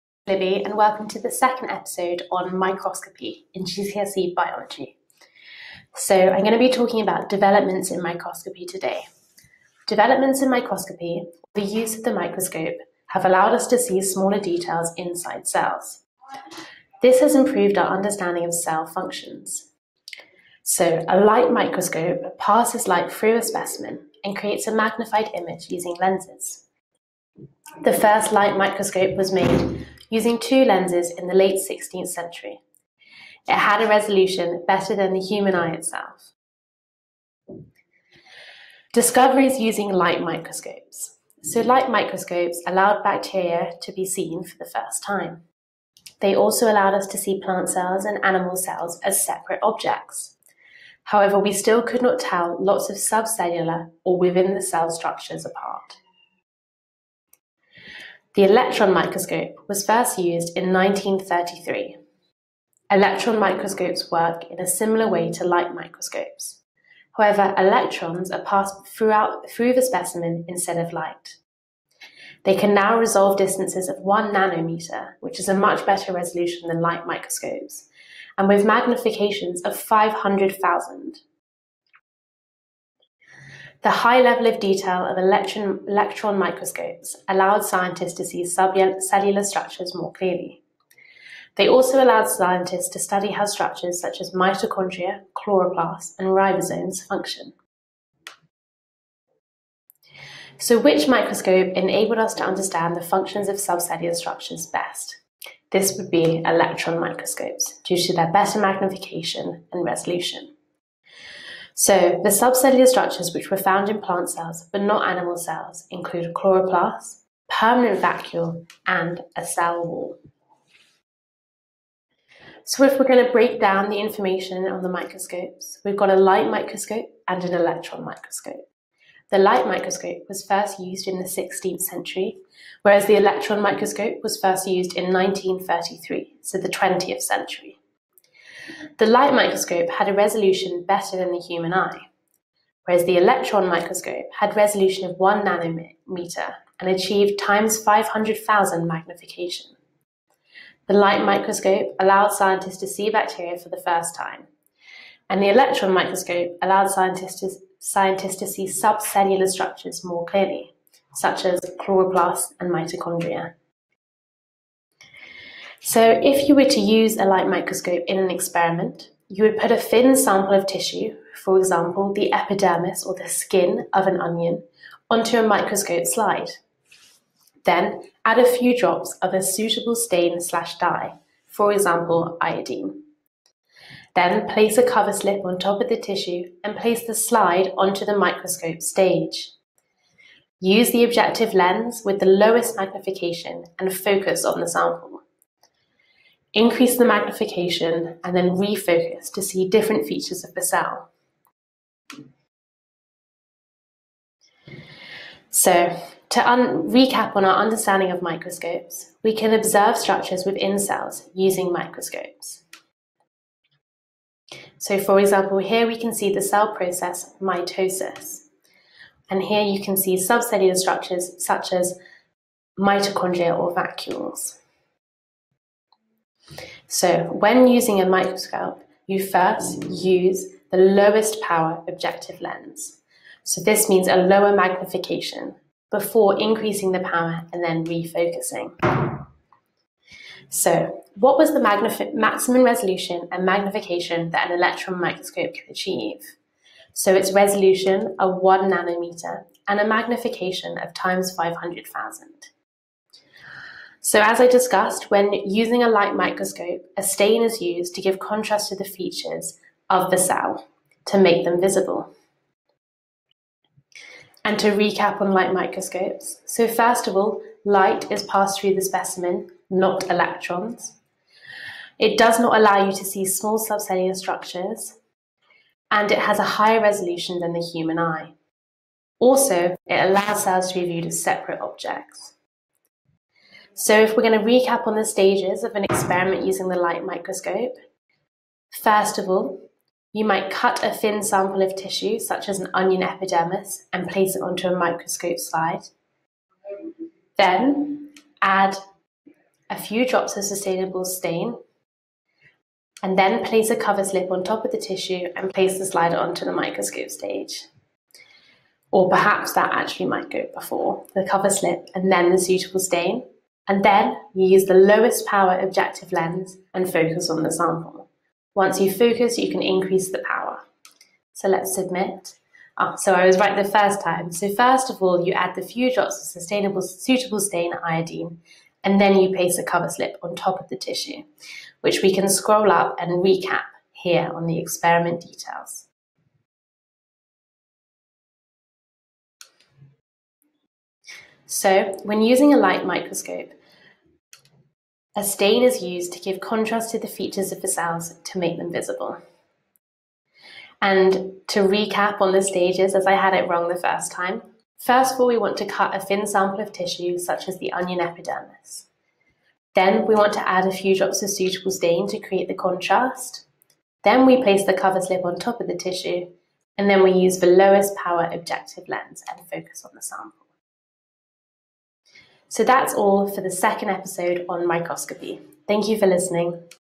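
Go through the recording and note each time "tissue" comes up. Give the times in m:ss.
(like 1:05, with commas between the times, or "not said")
2:50, 3:05, 4:51, 5:04, 5:30, 5:56, 6:05.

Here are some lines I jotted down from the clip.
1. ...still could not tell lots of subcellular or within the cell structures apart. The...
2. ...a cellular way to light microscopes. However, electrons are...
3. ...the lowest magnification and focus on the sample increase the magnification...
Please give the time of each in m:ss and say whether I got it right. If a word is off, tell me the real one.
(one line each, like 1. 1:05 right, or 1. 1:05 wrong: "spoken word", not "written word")
1. 0:51 right
2. 1:04 wrong: "similar", not "cellular"
3. 3:12 right.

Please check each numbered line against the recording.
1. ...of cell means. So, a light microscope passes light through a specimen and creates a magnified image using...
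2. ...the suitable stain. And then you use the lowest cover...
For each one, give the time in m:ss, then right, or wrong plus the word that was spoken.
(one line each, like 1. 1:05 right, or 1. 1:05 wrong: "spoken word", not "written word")
1. 0:18 wrong: "functions", not "means"
2. 5:12 wrong: "power", not "cover".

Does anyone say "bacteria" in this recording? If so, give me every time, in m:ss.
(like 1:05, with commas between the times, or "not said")
0:43, 2:33.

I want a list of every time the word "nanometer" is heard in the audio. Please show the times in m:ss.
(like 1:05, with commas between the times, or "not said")
1:14, 2:25, 4:08.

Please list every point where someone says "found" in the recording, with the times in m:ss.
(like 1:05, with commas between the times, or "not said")
1:53.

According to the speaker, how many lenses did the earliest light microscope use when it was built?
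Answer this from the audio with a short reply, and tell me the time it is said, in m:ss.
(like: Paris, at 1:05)
2, at 0:30.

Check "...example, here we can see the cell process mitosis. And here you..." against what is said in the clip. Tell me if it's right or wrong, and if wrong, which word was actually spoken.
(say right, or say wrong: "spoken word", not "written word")
right.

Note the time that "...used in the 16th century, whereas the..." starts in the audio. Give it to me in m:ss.
2:10.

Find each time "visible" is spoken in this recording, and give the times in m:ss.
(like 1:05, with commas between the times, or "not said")
4:21, 5:48.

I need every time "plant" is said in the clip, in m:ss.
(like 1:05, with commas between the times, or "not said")
0:47, 1:54.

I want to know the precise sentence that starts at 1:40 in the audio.
So, which microscope enabled us to understand the functions of subcellular structures best?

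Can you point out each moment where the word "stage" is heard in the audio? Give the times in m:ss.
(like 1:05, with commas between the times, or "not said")
3:08, 4:45, 5:07, 5:52.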